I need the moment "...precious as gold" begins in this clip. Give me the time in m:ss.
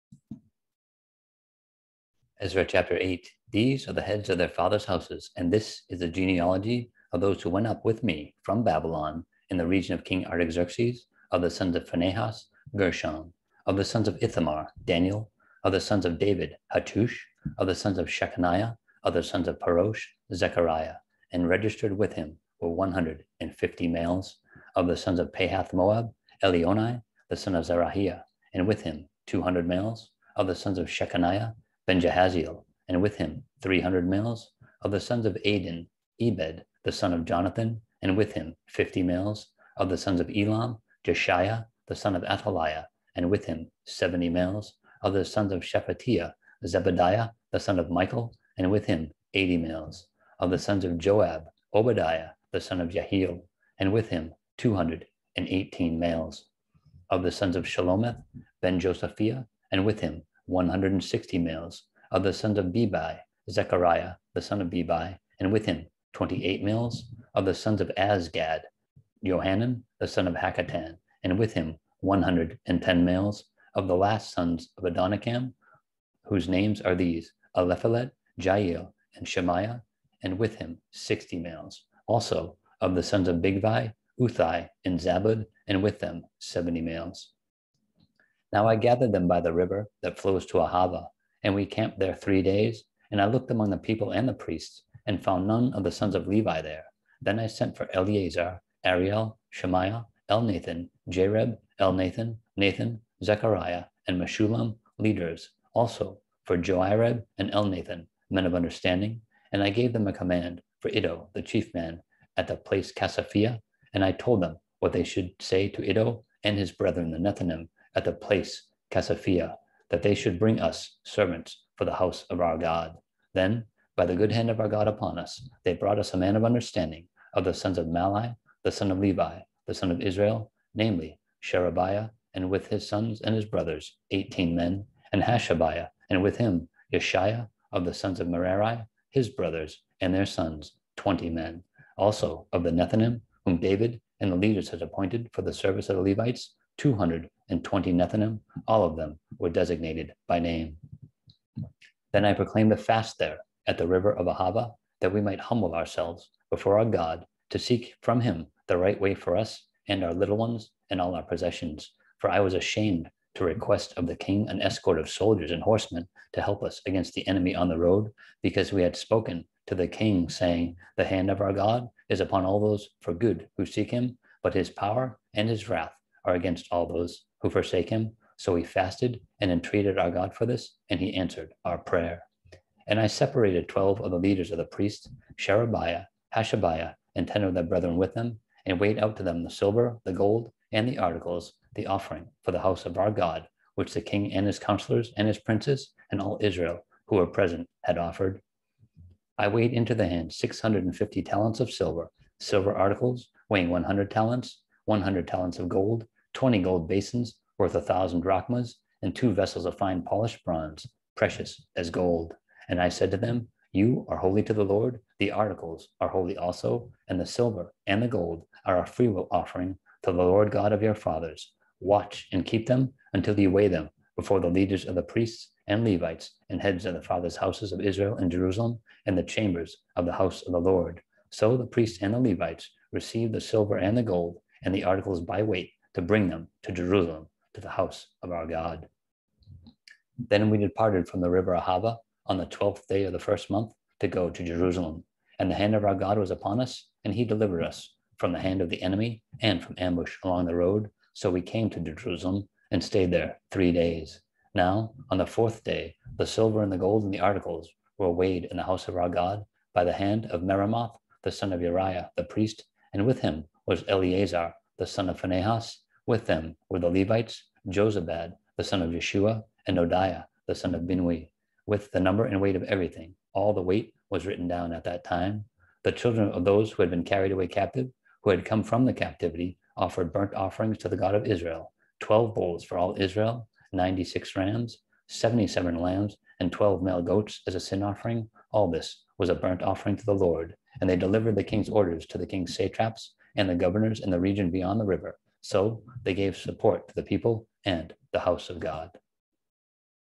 3:31.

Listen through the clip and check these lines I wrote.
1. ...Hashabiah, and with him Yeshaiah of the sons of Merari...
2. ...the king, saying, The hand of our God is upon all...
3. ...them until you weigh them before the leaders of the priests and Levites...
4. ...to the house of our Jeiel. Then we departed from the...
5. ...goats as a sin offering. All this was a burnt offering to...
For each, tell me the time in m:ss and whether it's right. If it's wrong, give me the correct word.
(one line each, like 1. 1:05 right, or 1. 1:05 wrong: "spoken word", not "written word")
1. 2:15 right
2. 2:49 right
3. 3:42 right
4. 3:57 wrong: "God", not "Jeiel"
5. 4:47 right.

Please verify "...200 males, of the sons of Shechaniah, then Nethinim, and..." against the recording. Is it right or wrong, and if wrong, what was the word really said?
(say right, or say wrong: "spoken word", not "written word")
wrong: "Jehaziel", not "Nethinim".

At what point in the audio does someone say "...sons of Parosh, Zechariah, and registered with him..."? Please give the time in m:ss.
0:19.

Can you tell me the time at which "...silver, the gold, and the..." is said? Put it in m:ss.
3:09.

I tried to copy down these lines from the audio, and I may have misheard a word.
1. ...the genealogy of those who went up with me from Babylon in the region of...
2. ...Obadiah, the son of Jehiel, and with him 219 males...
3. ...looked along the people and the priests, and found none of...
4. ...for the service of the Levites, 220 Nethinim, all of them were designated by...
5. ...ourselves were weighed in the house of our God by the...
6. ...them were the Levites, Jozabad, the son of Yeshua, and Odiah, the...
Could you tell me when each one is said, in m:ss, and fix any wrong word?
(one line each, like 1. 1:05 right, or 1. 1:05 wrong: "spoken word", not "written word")
1. 0:05 right
2. 0:51 wrong: "218", not "219"
3. 1:33 wrong: "among", not "along"
4. 2:25 right
5. 4:17 wrong: "articles", not "ourselves"
6. 4:26 right.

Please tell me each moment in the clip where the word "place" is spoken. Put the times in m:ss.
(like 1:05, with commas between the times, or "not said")
1:52, 1:58.